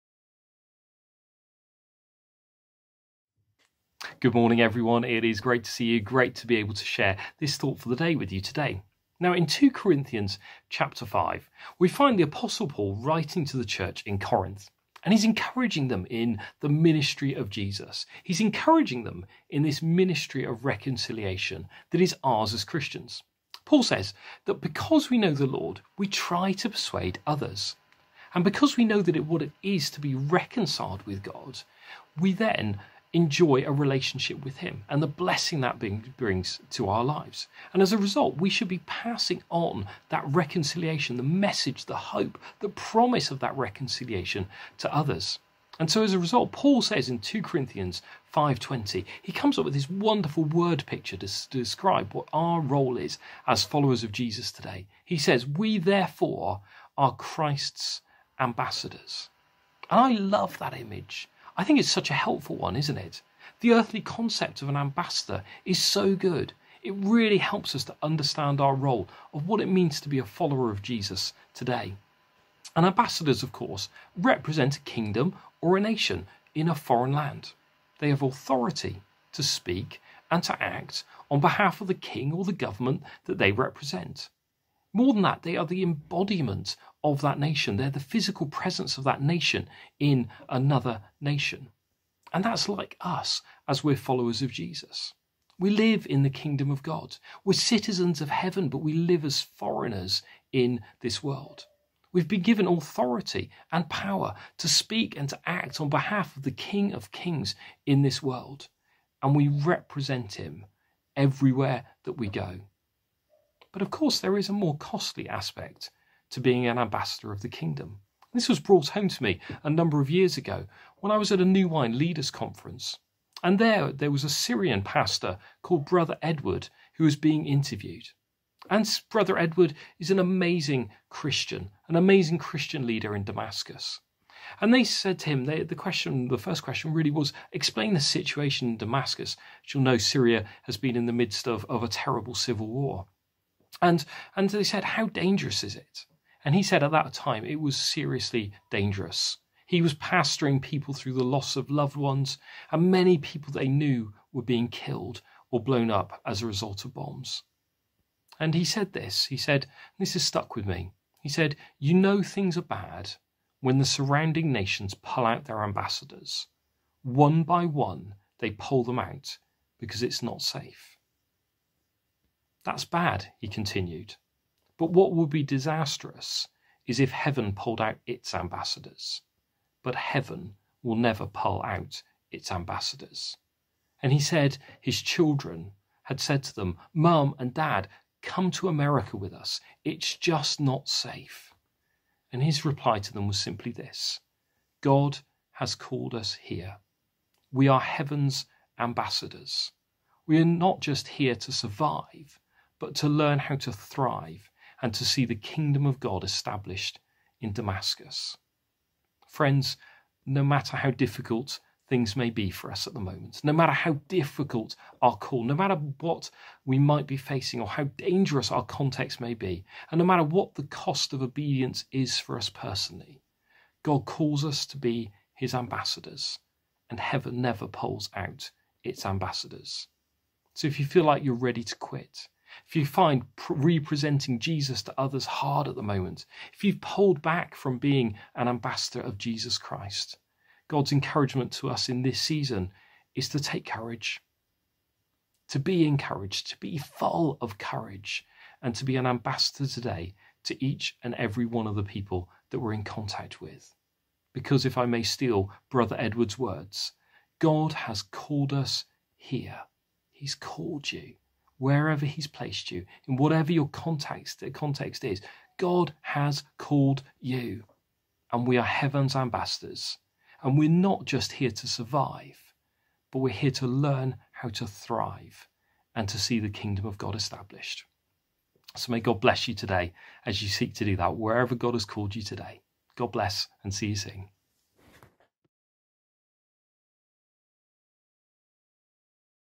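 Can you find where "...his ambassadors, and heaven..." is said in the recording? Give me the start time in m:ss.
3:45.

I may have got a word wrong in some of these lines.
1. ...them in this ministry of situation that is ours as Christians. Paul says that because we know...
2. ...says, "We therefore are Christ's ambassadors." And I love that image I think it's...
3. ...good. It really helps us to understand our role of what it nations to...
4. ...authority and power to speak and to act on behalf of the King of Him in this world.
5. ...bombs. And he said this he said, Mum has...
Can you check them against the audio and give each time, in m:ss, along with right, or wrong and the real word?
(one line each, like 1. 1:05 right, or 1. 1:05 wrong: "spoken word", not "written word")
1. 0:19 wrong: "reconciliation", not "situation"
2. 0:55 right
3. 1:06 wrong: "means", not "nations"
4. 1:42 wrong: "Kings", not "Him"
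5. 2:36 wrong: "This", not "Mum".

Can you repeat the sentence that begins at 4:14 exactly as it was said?
Because if I may steal Brother Edward's words, God has called us here.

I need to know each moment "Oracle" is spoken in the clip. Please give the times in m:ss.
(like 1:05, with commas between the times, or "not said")
not said.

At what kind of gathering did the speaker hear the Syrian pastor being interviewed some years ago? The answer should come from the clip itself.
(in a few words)
New Wine Leaders Conference.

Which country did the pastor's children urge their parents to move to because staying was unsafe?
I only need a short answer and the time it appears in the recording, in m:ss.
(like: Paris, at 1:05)
America, at 3:08.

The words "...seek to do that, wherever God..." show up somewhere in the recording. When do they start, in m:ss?
4:40.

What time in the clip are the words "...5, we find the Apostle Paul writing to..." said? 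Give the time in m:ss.
0:11.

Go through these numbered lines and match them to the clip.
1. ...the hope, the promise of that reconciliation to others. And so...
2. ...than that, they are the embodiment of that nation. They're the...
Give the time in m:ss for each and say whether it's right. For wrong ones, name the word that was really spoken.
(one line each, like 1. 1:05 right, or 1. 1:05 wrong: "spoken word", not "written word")
1. 0:41 right
2. 1:25 right.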